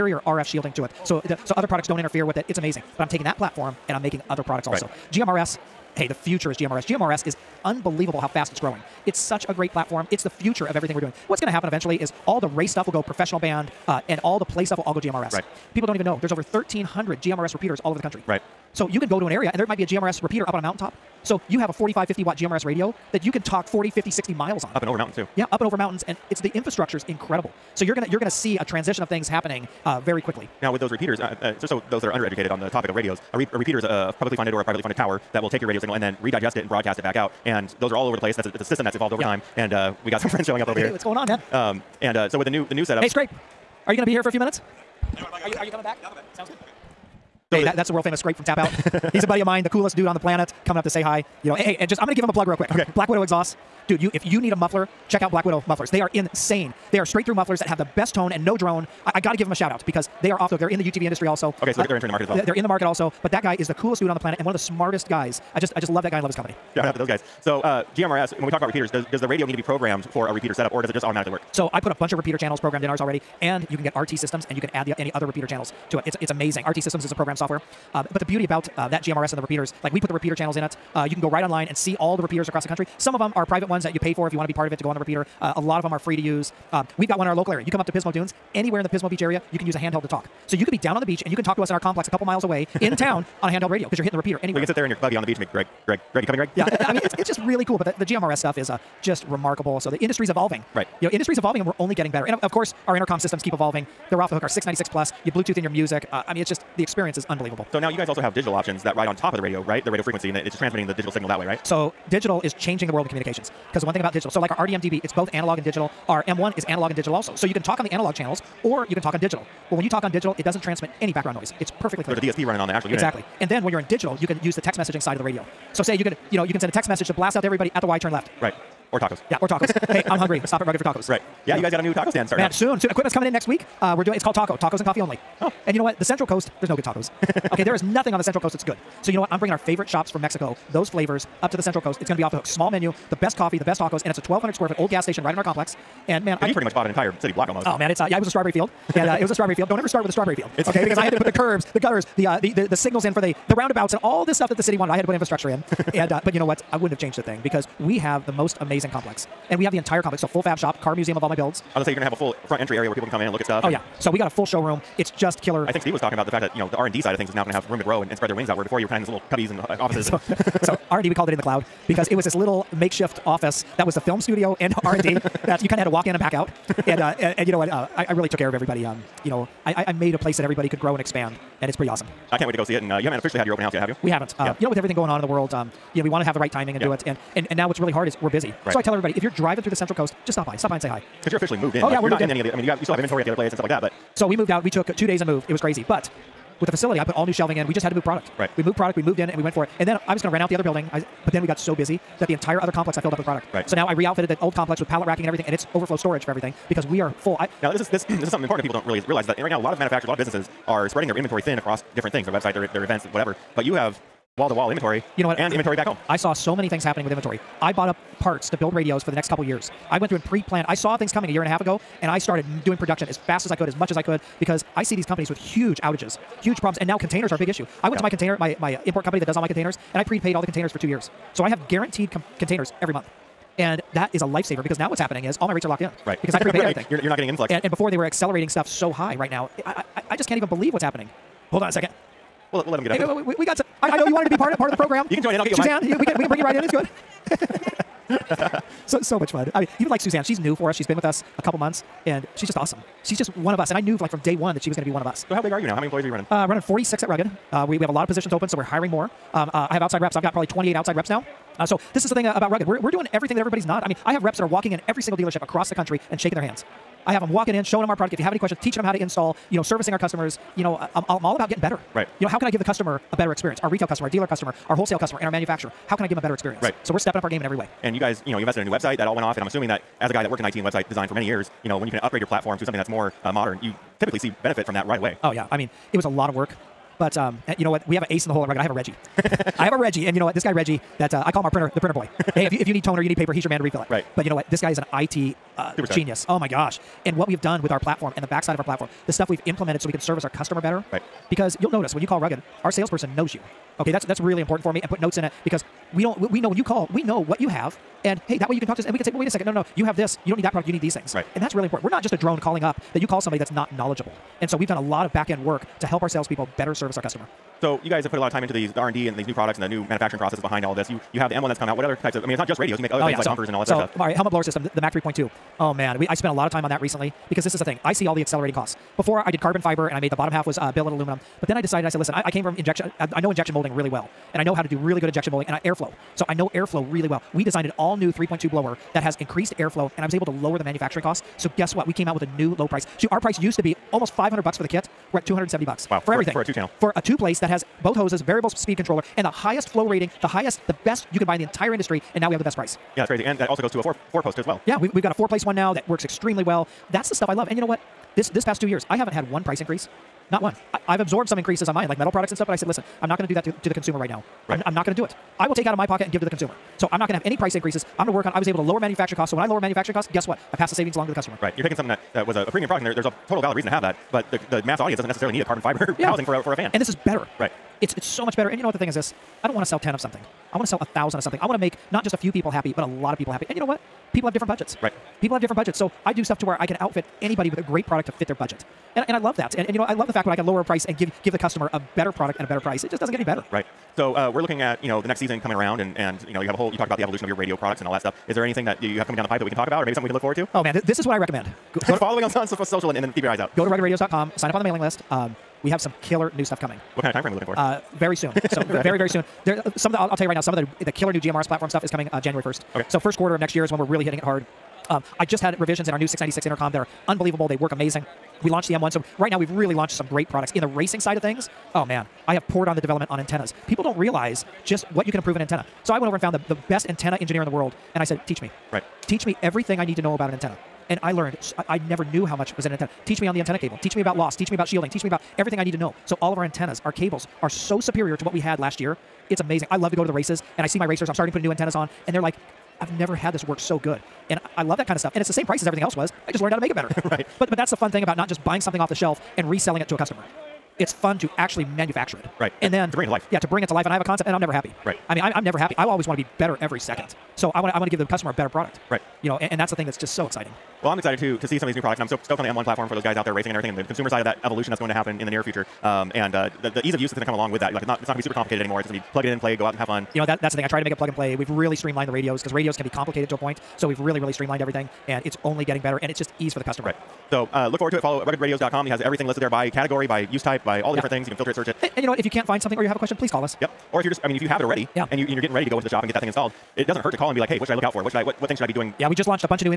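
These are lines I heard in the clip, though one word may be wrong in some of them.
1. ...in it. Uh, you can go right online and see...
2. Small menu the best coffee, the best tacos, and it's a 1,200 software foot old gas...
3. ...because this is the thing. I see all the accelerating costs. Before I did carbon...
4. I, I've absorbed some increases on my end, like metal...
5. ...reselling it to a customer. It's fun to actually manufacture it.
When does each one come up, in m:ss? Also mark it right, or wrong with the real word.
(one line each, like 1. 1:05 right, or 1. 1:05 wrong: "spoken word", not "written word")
1. 1:20 right
2. 2:22 wrong: "square", not "software"
3. 5:27 right
4. 6:00 right
5. 7:29 right.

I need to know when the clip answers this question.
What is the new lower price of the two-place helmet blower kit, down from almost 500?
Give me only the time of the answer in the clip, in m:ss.
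5:45.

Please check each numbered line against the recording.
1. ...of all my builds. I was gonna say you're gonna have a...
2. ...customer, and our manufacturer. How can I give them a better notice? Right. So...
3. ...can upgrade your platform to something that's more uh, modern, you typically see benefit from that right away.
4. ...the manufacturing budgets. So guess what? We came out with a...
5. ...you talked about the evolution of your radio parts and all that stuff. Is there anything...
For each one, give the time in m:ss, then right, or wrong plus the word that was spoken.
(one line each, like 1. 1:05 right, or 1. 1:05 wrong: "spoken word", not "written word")
1. 2:41 right
2. 4:34 wrong: "experience", not "notice"
3. 4:41 right
4. 5:40 wrong: "costs", not "budgets"
5. 6:36 wrong: "products", not "parts".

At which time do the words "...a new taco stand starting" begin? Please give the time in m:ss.
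2:11.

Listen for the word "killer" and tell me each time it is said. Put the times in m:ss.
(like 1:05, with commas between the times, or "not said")
2:45, 6:46, 6:50.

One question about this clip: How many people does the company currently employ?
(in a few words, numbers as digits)
46.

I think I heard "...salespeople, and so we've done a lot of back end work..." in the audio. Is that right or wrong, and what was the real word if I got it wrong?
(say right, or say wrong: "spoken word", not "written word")
wrong: "knowledgeable", not "salespeople".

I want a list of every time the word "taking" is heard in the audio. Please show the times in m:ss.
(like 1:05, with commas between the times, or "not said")
0:03, 6:11.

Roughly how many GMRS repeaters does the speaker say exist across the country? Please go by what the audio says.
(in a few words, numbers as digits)
over 1,300.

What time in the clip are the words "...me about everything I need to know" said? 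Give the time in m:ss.
7:15.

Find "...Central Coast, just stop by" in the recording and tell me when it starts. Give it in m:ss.
3:09.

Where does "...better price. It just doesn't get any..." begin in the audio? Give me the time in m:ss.
6:32.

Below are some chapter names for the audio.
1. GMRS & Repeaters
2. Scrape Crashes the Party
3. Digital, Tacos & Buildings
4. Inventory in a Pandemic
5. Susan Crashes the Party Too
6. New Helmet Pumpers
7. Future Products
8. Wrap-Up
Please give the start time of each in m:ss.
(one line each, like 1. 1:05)
1. 0:05
2. 0:39
3. 1:47
4. 3:23
5. 4:01
6. 5:17
7. 6:35
8. 7:56.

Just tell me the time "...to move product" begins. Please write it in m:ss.
3:17.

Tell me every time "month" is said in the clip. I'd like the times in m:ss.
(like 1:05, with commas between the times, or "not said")
3:52, 4:11.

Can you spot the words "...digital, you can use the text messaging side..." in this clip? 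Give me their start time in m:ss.
2:03.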